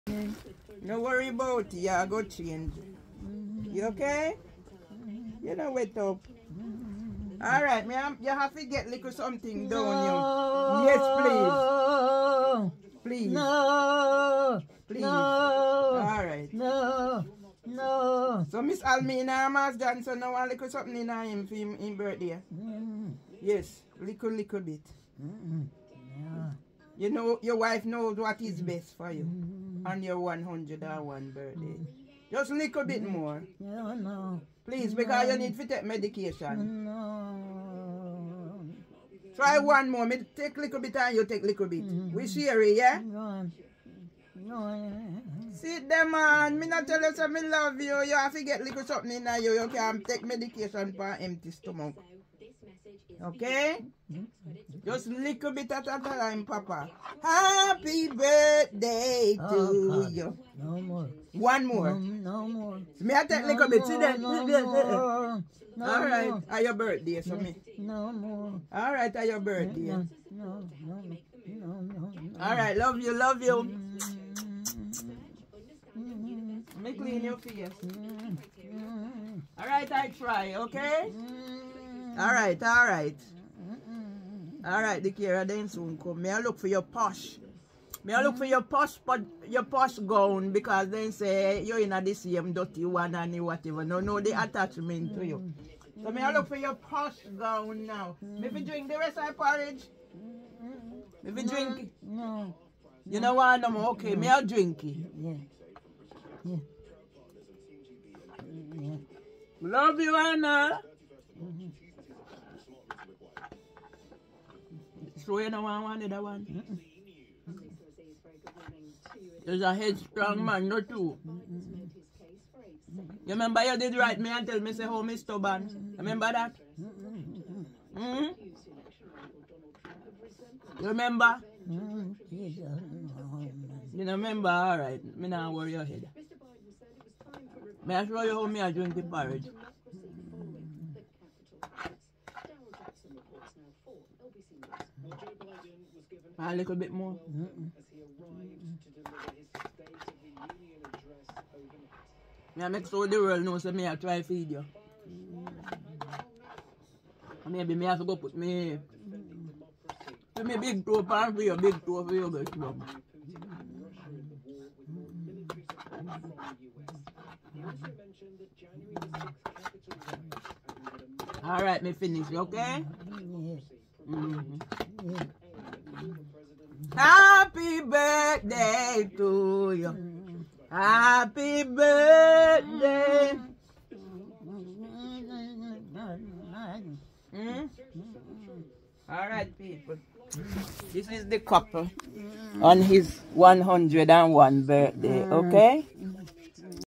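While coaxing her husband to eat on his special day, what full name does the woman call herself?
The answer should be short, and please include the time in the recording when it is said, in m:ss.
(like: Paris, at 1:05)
Almina Mas Johnson, at 0:18.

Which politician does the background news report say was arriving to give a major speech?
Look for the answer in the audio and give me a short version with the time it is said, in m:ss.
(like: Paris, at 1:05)
Joe Biden, at 2:25.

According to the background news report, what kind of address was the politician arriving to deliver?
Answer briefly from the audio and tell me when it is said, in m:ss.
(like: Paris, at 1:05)
State of the Union, at 2:29.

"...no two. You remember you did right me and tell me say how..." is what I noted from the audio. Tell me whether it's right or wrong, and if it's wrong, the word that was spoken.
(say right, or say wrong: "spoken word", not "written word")
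right.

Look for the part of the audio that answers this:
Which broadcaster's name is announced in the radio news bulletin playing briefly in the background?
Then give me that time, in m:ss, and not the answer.
2:24.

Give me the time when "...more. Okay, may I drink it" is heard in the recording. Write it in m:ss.
1:43.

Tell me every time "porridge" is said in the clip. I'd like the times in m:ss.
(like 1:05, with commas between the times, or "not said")
1:39, 2:19.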